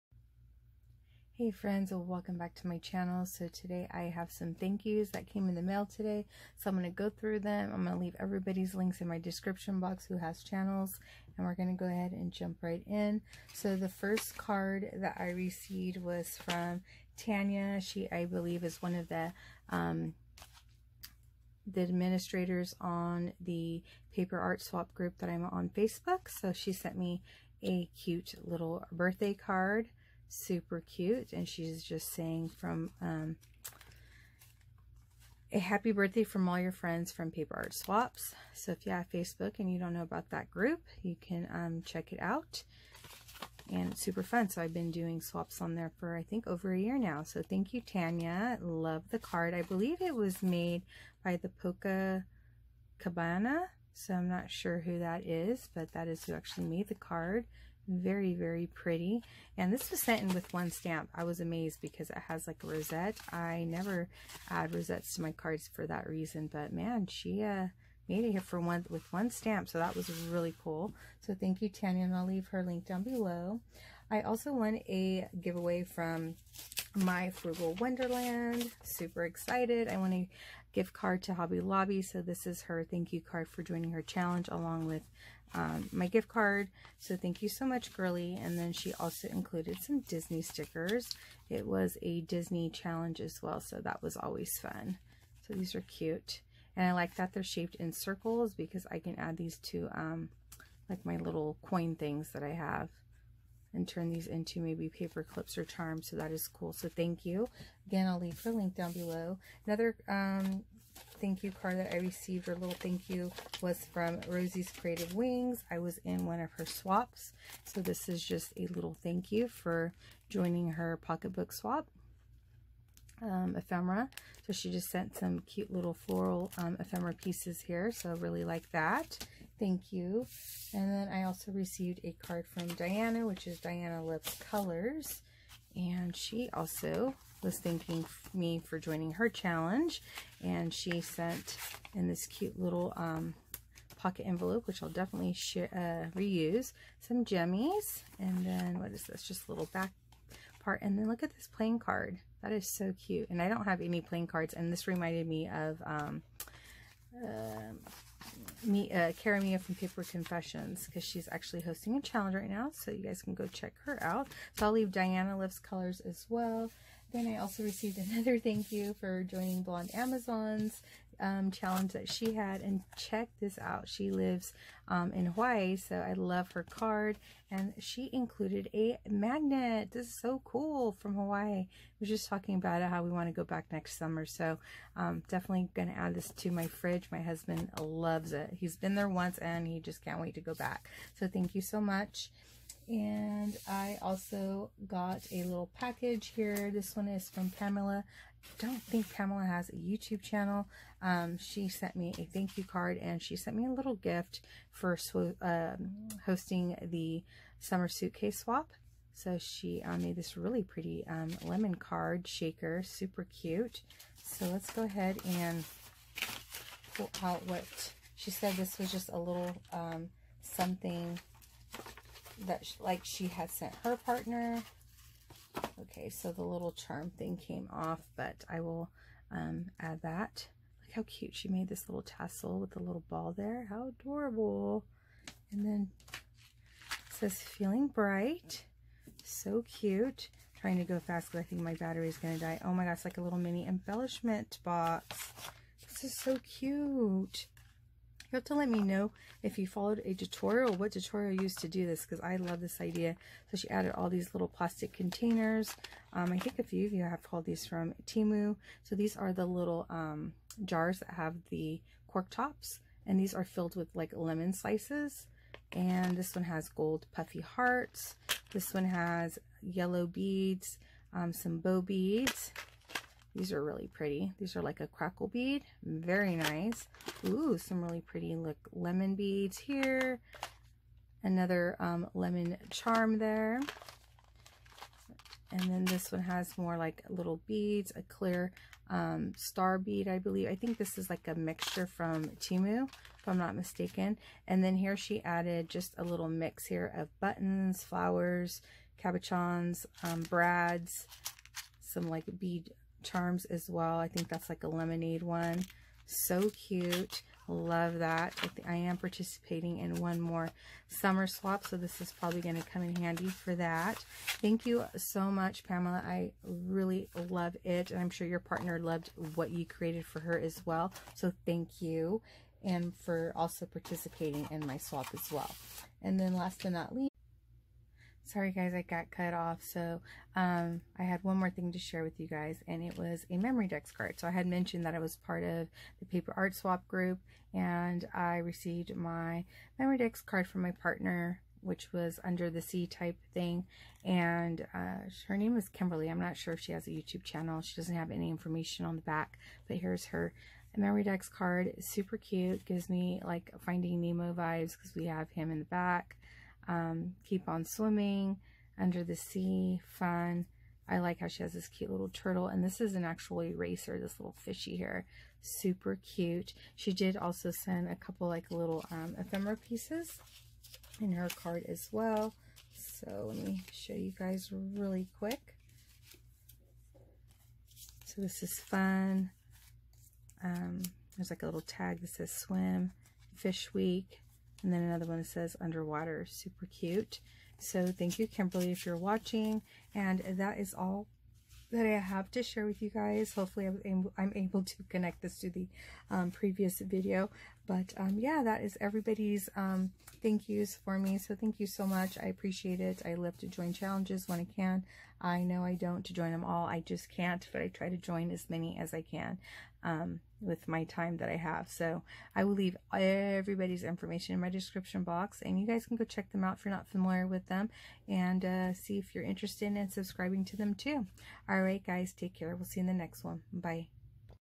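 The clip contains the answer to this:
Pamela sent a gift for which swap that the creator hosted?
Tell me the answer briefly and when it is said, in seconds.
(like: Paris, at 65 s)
Summer suitcase swap, at 207 s.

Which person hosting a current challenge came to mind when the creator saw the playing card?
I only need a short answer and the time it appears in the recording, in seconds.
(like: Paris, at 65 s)
Cara Mia, at 159 s.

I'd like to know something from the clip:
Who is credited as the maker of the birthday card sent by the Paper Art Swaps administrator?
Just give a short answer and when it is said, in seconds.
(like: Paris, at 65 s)
Polka Cabana, at 51 s.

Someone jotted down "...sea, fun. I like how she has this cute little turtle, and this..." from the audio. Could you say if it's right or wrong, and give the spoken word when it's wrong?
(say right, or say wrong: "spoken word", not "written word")
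right.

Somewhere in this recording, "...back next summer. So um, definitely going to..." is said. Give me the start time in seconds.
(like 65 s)
183 s.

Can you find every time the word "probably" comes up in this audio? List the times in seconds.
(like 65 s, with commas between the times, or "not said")
312 s.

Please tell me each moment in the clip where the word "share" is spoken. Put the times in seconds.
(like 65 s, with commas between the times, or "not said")
331 s, 392 s.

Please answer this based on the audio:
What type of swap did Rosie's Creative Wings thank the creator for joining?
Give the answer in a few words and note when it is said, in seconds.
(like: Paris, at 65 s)
Pocketbook swap, at 120 s.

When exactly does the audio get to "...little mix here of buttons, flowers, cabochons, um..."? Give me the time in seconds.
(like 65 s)
296 s.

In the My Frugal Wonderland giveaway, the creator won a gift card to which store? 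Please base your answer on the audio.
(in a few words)
Hobby Lobby.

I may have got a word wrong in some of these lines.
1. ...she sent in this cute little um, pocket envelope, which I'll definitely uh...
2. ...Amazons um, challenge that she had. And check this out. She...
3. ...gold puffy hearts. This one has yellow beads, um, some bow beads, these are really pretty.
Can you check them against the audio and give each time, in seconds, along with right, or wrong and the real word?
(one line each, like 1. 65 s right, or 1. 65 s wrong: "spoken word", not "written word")
1. 140 s right
2. 169 s right
3. 266 s right.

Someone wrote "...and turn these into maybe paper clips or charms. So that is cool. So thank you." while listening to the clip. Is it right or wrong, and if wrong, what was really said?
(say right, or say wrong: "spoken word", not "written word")
right.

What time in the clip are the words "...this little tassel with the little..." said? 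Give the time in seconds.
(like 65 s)
231 s.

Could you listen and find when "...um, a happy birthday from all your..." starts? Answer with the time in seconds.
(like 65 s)
33 s.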